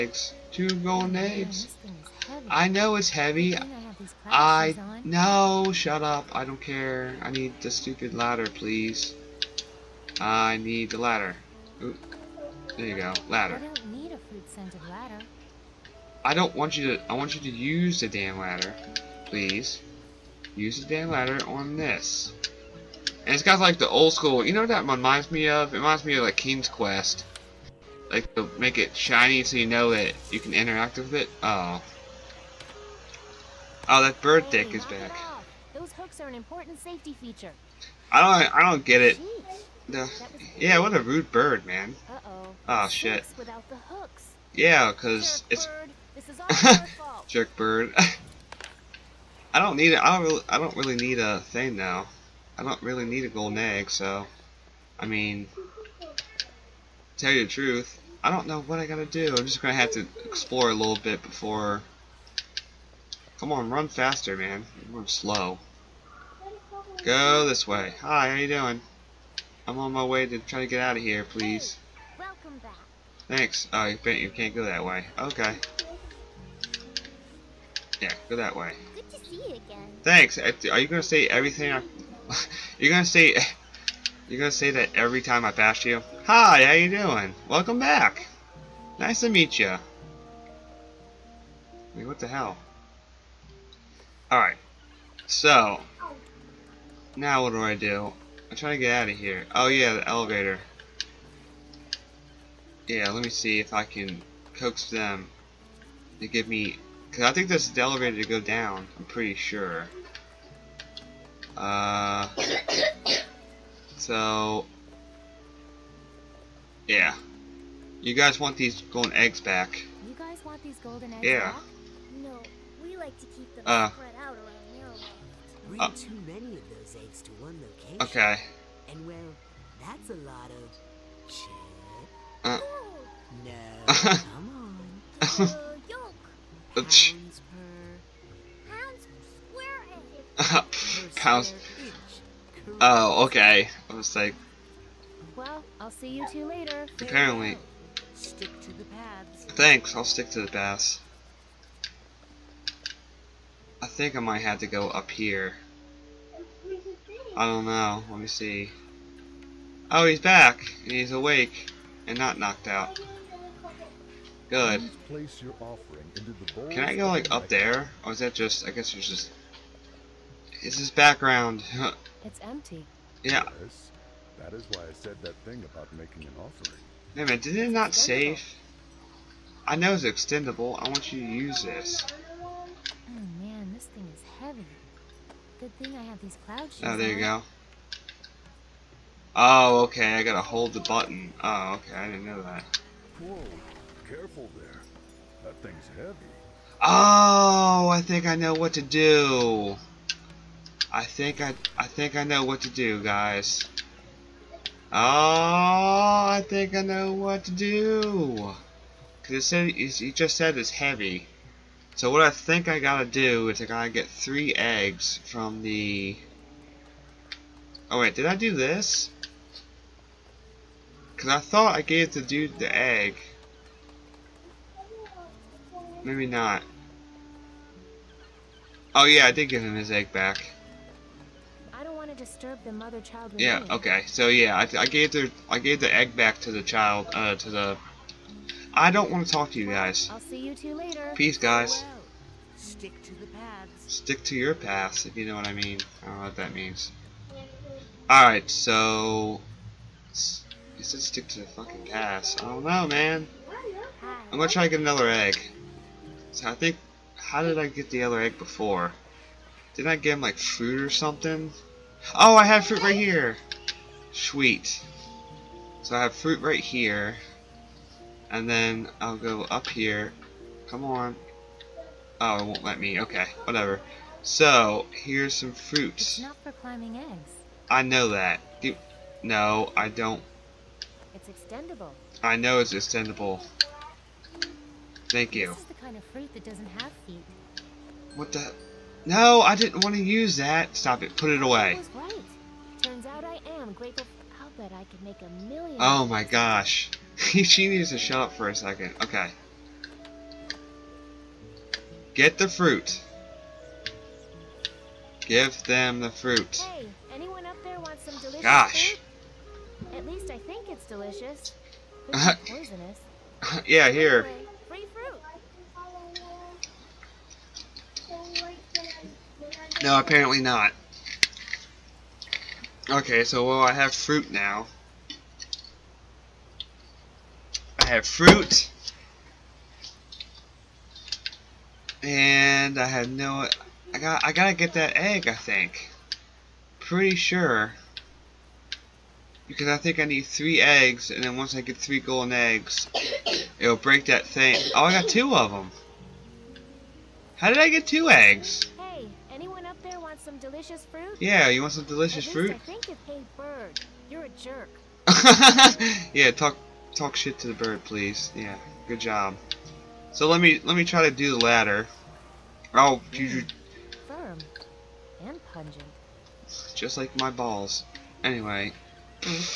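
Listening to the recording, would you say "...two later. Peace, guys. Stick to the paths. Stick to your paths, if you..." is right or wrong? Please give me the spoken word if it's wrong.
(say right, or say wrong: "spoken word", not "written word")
right.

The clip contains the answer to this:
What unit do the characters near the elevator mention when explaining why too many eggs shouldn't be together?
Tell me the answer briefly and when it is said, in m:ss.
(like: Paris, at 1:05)
pounds per square, at 2:20.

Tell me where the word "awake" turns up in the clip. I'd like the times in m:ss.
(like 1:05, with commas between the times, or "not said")
2:41.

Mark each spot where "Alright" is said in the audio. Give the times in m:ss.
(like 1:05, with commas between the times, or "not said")
1:34, 4:08.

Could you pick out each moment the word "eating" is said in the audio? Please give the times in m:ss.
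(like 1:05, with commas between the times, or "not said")
not said.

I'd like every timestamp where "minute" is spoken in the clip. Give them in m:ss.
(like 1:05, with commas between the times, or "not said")
2:57.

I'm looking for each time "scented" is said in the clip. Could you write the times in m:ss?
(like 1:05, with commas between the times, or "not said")
0:14.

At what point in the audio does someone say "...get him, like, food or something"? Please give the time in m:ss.
4:19.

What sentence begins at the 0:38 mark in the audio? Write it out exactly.
I don't I don't get it.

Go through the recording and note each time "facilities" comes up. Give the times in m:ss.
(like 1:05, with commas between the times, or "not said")
not said.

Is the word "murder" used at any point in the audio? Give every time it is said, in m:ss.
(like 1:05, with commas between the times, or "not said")
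not said.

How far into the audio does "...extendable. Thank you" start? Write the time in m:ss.
4:42.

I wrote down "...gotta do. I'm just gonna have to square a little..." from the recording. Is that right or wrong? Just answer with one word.
wrong.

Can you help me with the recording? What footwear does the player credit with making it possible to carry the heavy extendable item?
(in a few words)
cloud shoes.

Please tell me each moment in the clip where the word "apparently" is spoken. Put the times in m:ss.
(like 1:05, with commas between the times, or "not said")
2:26, 5:19.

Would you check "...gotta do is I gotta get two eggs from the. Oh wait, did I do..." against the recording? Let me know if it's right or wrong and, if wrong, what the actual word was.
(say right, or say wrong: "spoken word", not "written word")
wrong: "three", not "two".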